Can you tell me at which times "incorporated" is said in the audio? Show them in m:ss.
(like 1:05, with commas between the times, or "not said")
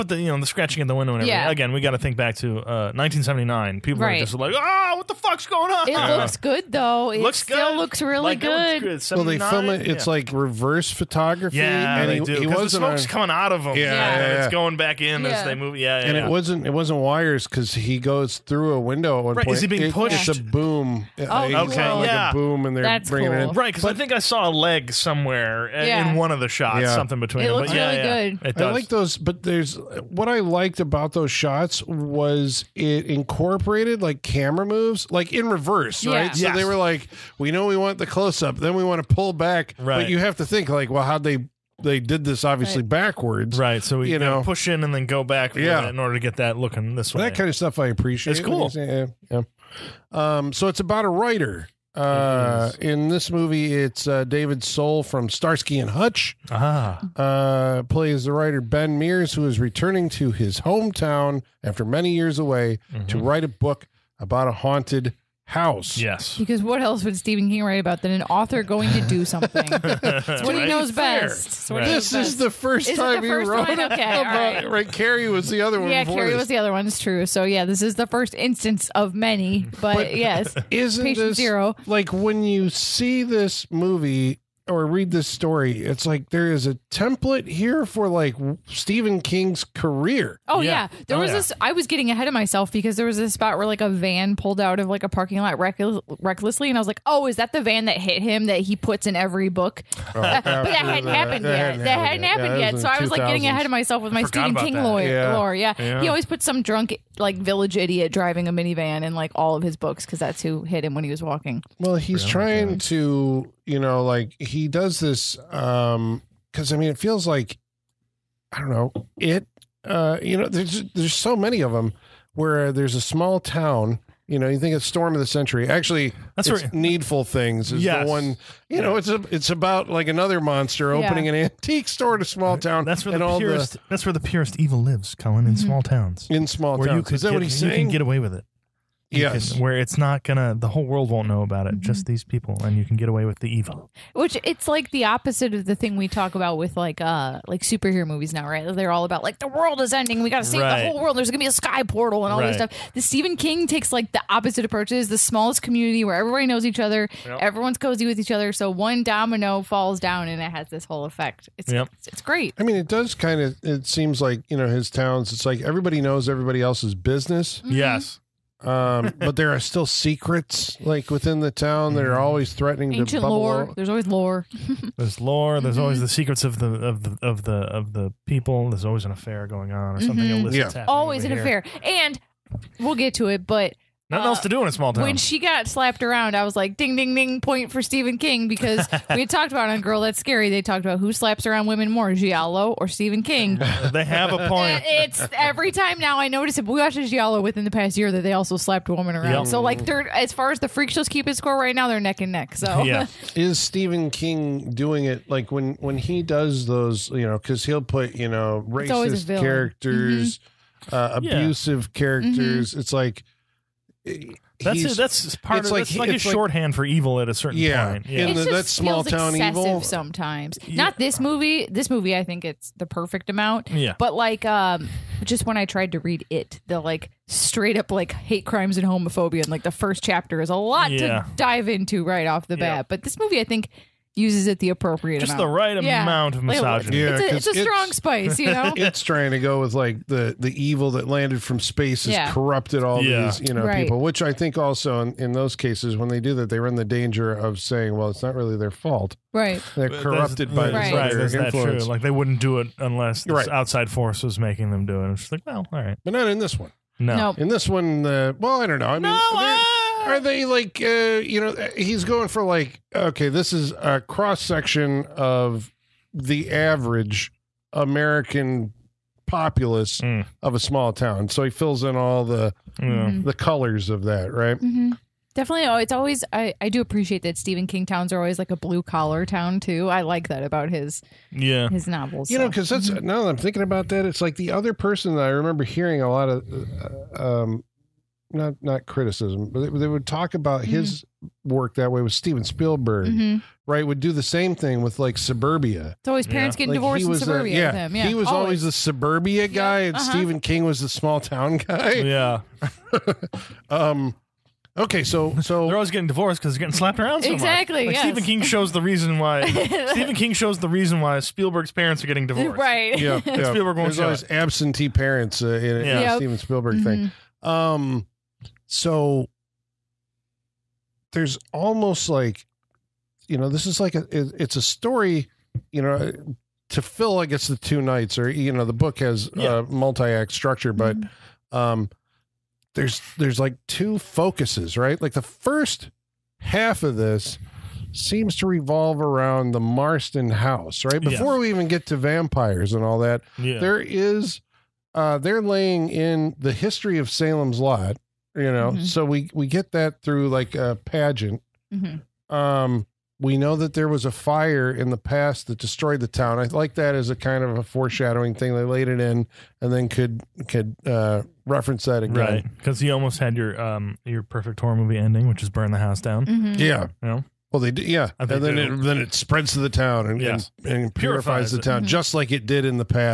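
0:33.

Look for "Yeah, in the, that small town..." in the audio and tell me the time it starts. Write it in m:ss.
3:38.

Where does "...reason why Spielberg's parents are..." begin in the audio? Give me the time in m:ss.
5:10.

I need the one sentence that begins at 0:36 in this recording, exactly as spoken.
So they were like, we know we want the close up then we want to pull back.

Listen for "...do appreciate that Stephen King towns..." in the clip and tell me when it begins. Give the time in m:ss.
4:36.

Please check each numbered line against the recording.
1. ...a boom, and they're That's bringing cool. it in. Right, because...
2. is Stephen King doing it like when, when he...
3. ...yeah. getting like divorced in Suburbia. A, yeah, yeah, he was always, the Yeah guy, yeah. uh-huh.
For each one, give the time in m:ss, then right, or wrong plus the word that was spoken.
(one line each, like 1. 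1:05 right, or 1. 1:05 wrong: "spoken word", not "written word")
1. 0:22 right
2. 3:23 right
3. 4:56 wrong: "Suburbia", not "Yeah".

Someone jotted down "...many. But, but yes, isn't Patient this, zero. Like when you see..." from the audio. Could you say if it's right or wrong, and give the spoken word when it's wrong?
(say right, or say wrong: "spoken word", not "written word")
right.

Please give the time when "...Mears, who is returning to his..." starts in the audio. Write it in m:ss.
0:58.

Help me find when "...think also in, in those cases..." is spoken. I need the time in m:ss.
4:04.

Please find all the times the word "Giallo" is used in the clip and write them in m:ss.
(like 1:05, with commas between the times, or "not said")
3:12, 3:17.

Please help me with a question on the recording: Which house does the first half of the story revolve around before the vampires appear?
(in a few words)
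the Marston house.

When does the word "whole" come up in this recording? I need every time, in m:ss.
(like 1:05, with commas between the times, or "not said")
2:20, 2:30, 2:40.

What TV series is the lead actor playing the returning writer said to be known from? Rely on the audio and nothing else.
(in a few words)
Starsky and Hutch.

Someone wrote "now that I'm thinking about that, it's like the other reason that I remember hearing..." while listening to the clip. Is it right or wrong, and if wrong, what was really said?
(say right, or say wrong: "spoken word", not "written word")
wrong: "person", not "reason".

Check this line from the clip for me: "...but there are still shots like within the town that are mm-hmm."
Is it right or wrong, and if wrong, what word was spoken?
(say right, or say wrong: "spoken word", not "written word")
wrong: "secrets", not "shots".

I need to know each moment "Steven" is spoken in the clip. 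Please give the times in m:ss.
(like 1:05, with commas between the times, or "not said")
4:52, 5:16.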